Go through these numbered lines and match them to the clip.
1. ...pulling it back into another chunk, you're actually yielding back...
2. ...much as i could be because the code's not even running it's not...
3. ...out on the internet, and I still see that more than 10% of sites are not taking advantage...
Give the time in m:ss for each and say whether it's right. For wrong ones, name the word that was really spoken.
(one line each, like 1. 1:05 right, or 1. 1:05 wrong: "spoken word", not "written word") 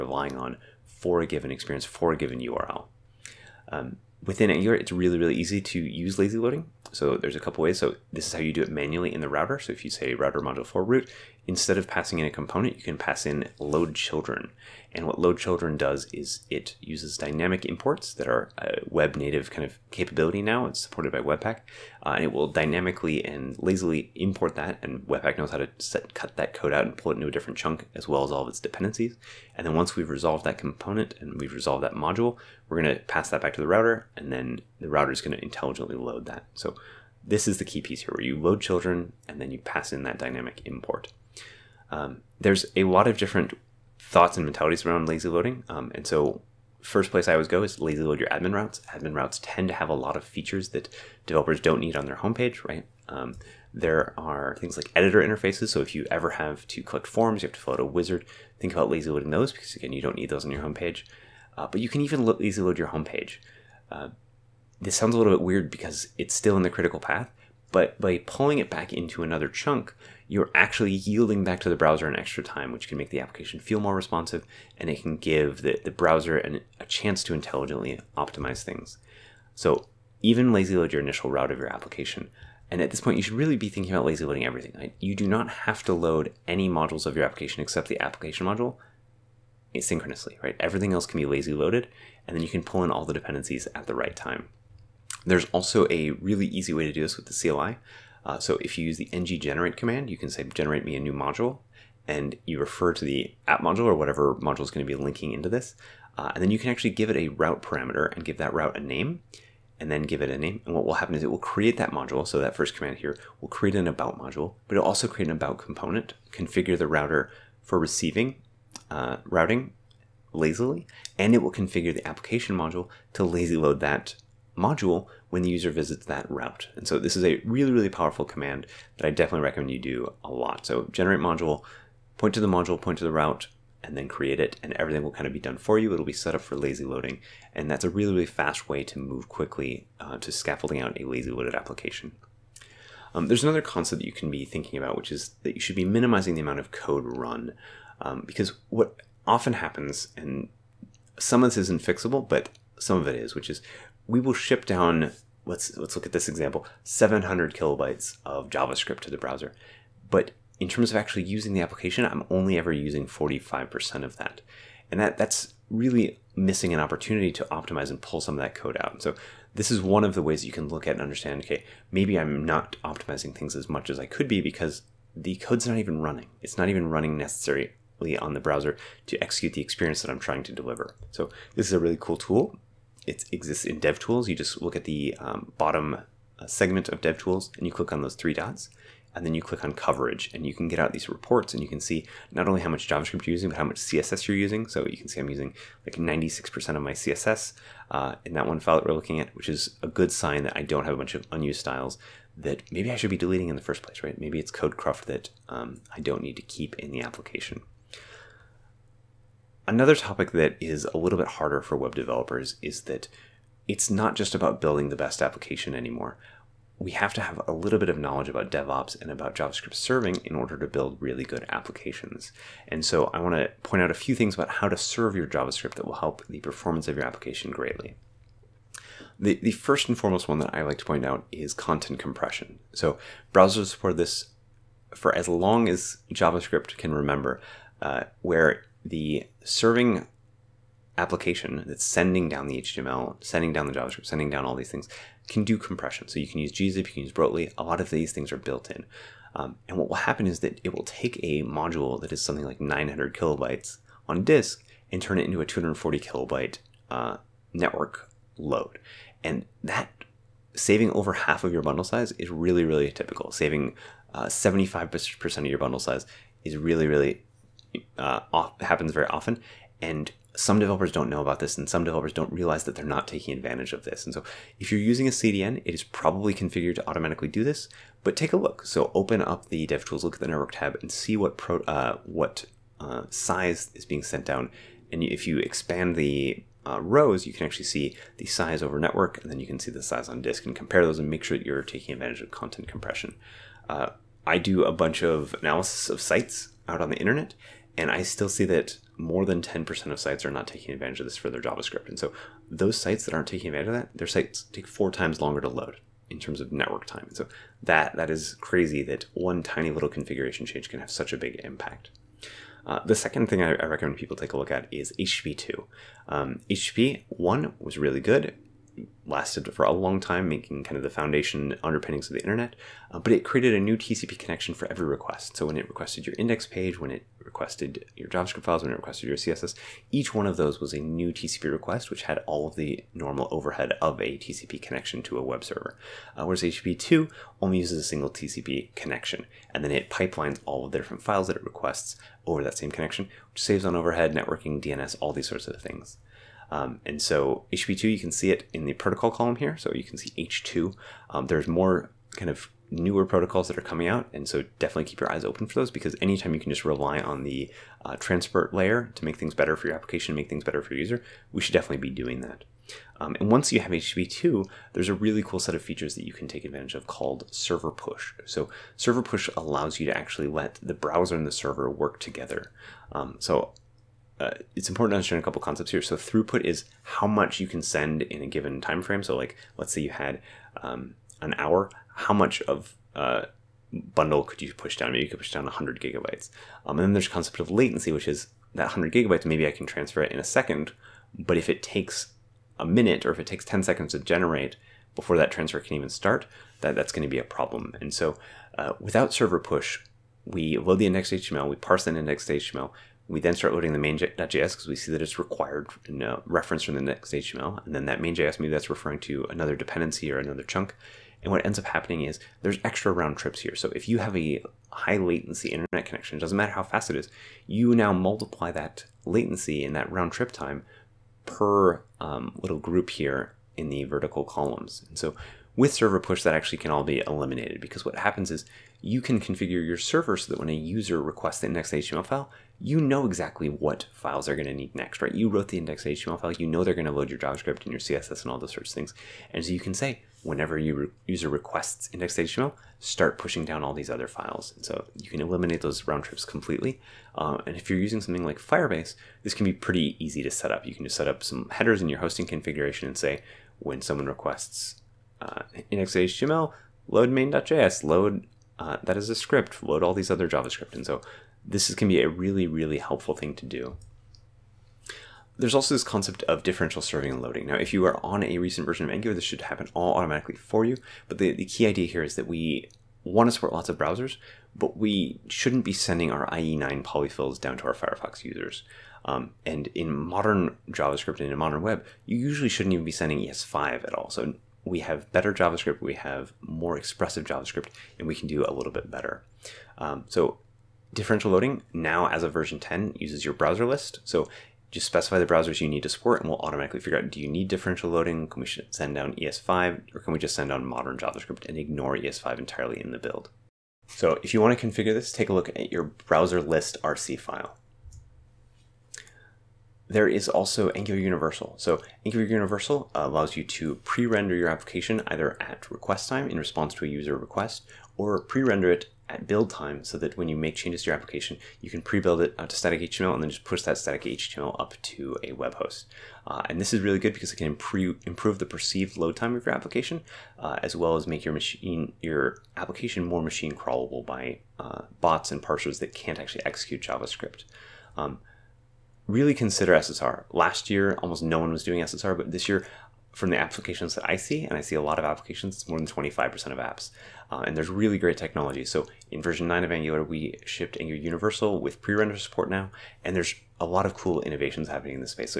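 1. 1:08 right
2. 2:53 right
3. 4:56 right.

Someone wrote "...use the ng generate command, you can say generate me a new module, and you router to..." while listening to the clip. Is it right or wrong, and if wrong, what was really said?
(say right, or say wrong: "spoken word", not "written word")
wrong: "refer", not "router".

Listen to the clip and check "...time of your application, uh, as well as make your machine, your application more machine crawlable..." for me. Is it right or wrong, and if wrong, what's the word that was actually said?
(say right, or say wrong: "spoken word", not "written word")
right.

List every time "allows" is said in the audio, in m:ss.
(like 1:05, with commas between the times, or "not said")
6:09, 8:32.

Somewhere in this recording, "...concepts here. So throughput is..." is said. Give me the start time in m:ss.
6:15.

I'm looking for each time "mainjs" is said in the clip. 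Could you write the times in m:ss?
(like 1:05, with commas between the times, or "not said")
6:43, 6:47, 7:37.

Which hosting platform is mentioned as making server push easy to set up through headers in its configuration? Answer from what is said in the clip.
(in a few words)
Firebase.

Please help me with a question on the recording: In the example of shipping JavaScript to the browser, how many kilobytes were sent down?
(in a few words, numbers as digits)
700.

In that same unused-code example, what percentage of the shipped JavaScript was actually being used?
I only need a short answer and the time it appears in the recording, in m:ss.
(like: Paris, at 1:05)
45%, at 2:43.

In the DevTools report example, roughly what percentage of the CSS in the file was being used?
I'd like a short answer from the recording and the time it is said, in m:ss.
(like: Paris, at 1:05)
96%, at 3:15.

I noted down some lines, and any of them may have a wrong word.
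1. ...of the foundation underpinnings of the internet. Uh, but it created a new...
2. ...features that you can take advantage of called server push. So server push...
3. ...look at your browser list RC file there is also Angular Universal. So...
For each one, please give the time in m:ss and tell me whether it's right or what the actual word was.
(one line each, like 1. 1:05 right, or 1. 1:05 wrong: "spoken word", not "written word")
1. 5:20 right
2. 6:05 right
3. 8:25 right.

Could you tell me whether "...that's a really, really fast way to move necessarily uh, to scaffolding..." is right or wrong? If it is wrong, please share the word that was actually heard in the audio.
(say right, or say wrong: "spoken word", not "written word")
wrong: "quickly", not "necessarily".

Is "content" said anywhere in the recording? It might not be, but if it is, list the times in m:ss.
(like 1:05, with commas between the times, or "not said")
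3:51, 4:52.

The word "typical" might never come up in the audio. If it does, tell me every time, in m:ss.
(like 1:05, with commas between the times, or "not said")
4:22.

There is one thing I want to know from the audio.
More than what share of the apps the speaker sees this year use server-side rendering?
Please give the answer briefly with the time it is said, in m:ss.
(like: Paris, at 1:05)
25%, at 9:05.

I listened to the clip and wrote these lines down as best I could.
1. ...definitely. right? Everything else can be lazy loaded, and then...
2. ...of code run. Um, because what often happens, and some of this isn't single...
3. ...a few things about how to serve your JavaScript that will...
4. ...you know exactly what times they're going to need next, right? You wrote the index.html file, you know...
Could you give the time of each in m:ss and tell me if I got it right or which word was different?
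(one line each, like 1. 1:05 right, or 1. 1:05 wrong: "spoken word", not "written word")
1. 1:29 wrong: "asynchronously", not "definitely"
2. 2:26 wrong: "fixable", not "single"
3. 3:43 right
4. 7:12 wrong: "files", not "times".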